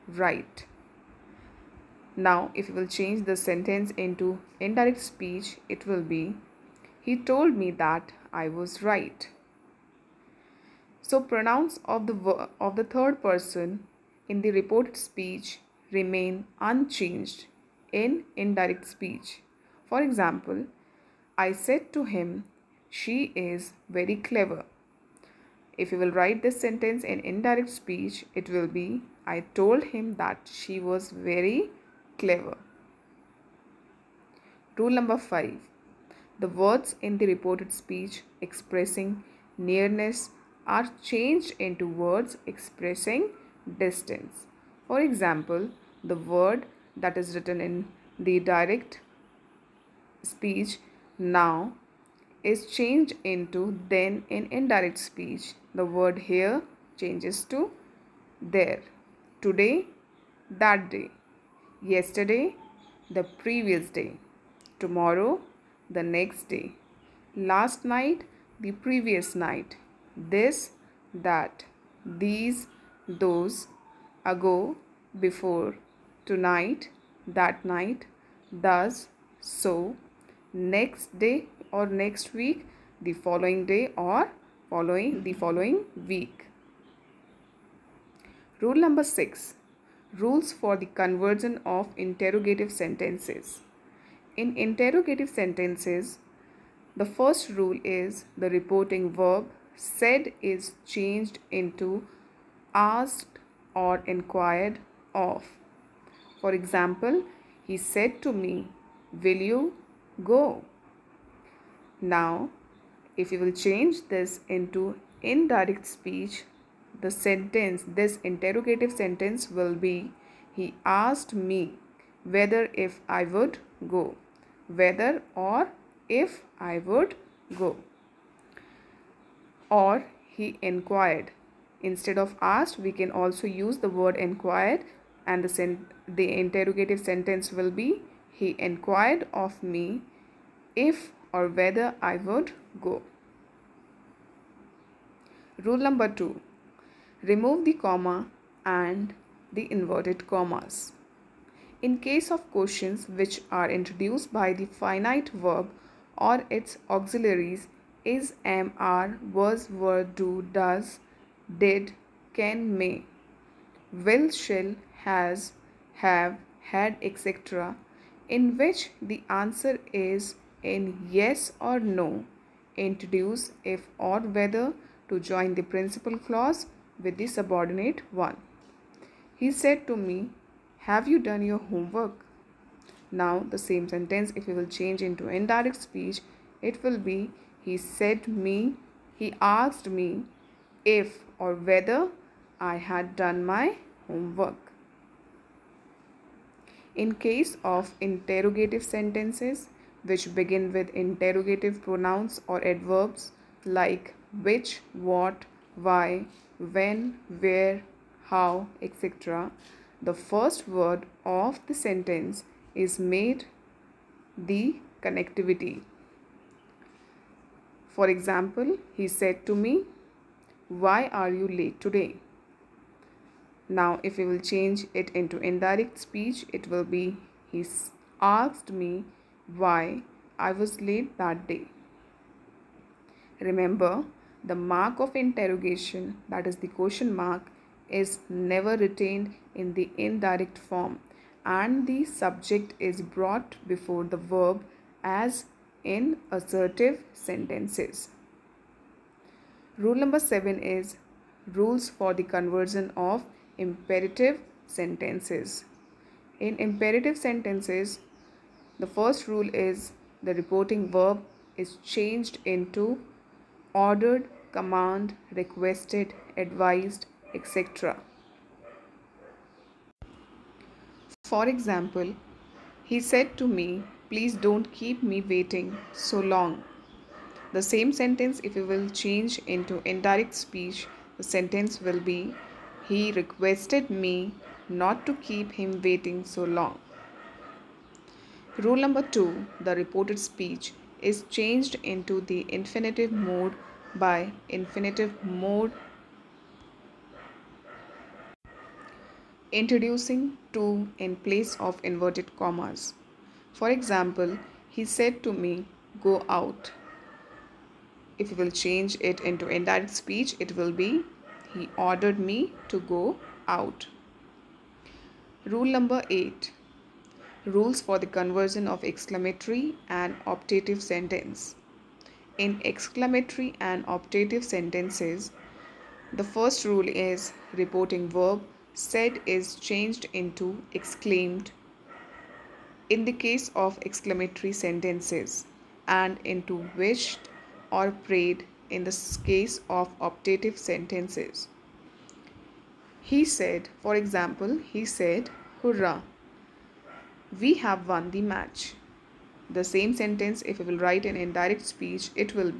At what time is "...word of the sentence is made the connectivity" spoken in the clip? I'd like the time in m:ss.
3:30.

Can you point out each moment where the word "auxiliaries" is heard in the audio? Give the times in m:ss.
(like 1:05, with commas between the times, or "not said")
2:36.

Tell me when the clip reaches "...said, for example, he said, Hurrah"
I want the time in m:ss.
5:43.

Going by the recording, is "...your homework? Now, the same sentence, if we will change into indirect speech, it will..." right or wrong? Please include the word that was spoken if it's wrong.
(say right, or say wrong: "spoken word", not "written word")
right.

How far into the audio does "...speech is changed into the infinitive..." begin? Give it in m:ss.
4:50.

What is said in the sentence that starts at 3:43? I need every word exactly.
Now, if we will change it into indirect speech, it will be He asked me why I was late that day.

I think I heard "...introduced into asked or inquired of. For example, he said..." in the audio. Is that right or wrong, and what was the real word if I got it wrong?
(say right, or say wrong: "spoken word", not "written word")
wrong: "changed", not "introduced".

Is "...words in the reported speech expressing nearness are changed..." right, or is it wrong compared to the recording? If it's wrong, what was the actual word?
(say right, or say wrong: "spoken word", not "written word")
right.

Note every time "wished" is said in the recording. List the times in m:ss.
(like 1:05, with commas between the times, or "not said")
5:36.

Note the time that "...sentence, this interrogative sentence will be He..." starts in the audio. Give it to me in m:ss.
1:57.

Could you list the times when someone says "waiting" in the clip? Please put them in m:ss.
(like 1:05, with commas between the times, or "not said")
4:35, 4:45.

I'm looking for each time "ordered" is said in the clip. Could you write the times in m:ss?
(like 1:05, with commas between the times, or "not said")
4:23, 5:11.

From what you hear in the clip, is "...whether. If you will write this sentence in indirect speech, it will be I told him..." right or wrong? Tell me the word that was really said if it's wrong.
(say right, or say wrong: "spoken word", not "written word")
wrong: "clever", not "whether".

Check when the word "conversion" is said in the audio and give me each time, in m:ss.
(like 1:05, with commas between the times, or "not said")
1:30, 4:12, 5:18.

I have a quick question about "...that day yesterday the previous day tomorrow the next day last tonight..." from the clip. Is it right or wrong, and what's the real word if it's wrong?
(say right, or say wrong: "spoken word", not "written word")
wrong: "night", not "tonight".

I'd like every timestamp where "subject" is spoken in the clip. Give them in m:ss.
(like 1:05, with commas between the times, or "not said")
4:02.